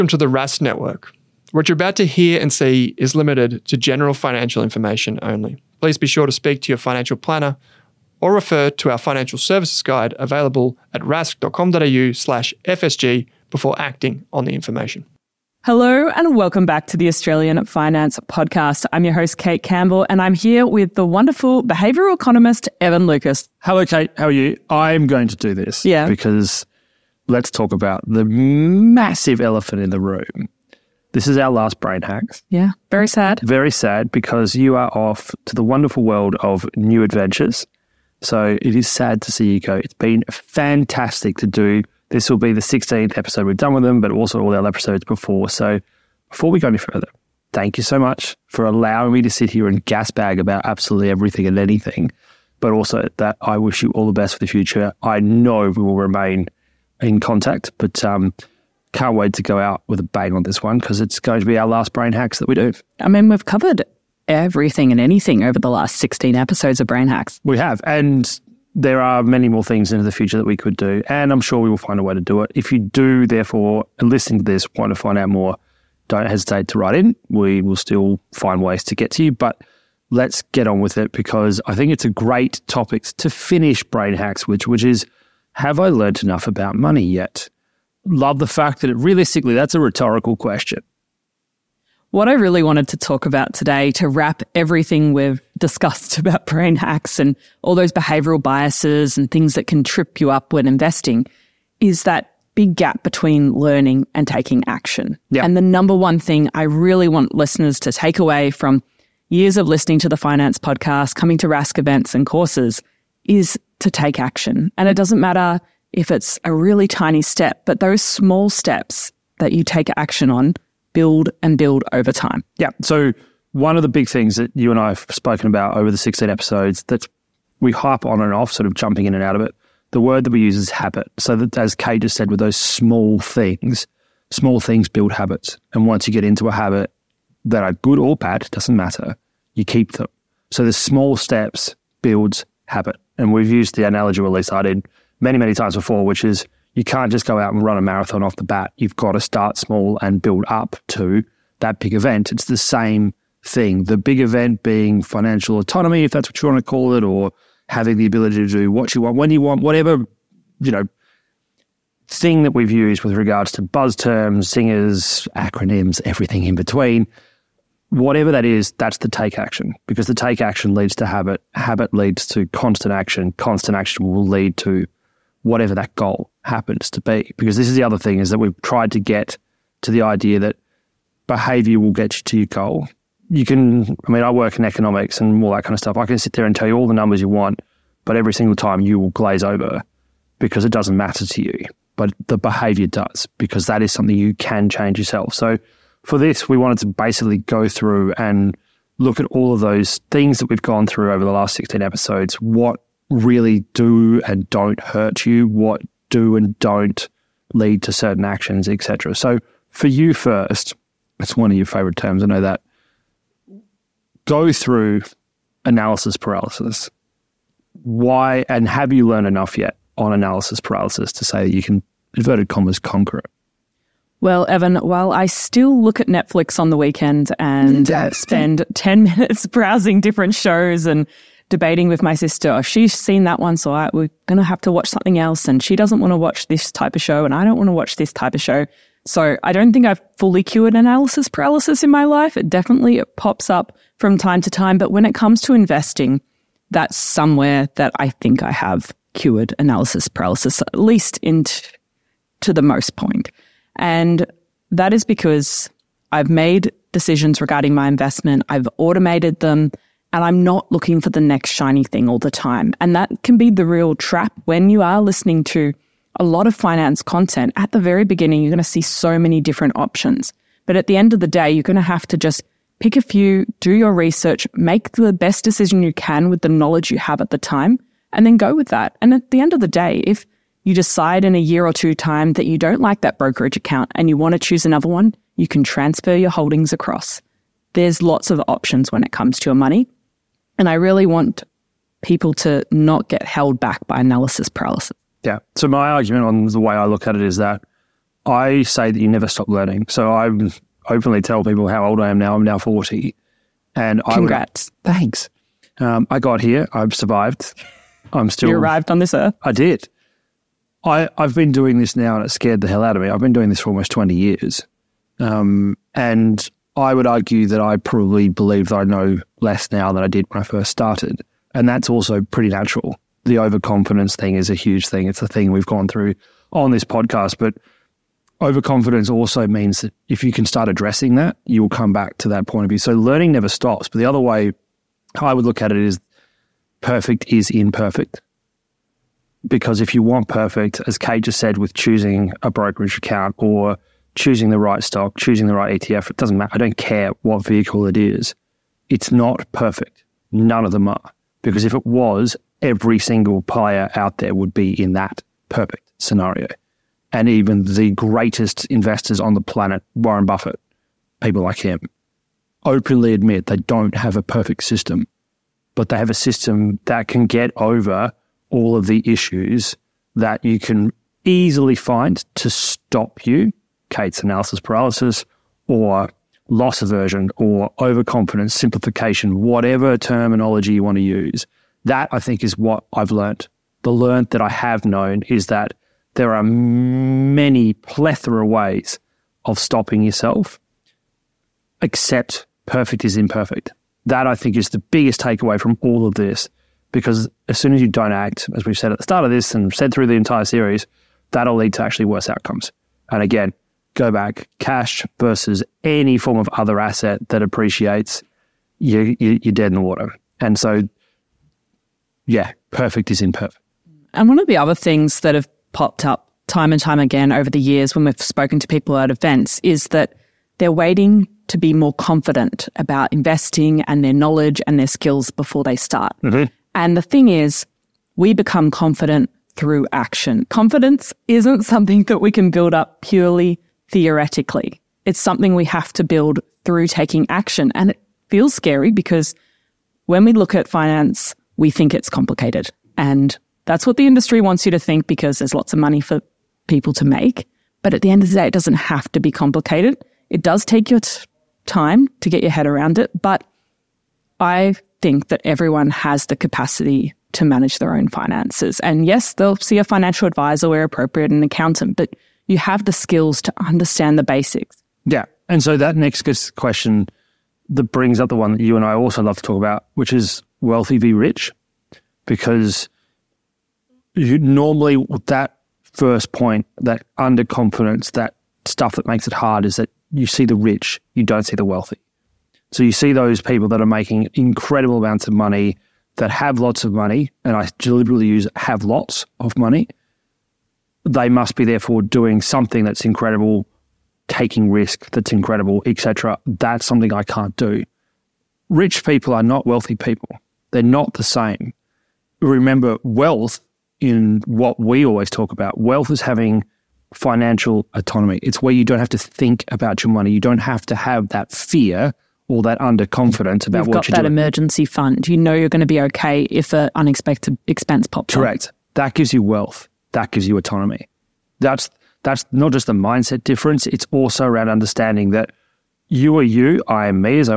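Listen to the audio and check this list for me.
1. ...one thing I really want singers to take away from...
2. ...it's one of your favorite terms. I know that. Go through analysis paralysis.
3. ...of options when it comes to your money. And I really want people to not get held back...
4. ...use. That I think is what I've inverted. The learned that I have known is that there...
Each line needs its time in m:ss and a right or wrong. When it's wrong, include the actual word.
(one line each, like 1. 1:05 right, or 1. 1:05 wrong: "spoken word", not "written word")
1. 1:45 wrong: "listeners", not "singers"
2. 3:31 right
3. 4:48 right
4. 6:21 wrong: "learned", not "inverted".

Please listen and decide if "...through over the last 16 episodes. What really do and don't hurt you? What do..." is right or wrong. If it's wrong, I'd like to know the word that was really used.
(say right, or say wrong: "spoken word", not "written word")
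right.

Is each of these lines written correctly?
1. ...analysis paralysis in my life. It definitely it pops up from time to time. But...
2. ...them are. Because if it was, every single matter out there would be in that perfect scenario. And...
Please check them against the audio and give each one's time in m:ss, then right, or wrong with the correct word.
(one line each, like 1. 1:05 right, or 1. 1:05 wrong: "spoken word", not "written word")
1. 4:00 right
2. 5:50 wrong: "player", not "matter".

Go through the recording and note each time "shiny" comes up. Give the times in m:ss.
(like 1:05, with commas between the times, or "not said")
4:21.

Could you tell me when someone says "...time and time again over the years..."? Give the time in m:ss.
6:56.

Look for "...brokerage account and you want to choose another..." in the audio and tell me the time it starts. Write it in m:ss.
4:43.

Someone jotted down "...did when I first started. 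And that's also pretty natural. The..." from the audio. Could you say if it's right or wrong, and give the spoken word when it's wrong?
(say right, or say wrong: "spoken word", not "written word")
right.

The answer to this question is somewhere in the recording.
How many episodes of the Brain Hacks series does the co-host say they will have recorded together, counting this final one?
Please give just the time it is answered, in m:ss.
0:42.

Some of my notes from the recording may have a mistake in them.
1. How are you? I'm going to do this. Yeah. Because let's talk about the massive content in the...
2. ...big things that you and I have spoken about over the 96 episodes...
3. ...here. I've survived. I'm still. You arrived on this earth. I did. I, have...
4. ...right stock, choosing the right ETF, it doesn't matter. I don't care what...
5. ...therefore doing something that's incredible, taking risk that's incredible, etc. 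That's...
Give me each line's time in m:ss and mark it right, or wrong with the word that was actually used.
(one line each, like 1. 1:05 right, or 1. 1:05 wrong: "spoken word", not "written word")
1. 0:24 wrong: "elephant", not "content"
2. 2:03 wrong: "16", not "96"
3. 5:06 right
4. 5:44 right
5. 8:11 right.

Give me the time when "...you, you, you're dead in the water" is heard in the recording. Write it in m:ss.
6:48.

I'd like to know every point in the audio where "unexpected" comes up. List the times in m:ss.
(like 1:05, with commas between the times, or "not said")
8:36.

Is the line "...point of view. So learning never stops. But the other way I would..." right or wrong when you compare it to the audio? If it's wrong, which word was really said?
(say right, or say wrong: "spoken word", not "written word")
right.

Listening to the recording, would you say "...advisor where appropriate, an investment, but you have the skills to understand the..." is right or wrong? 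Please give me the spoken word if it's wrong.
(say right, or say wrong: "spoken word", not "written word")
wrong: "accountant", not "investment".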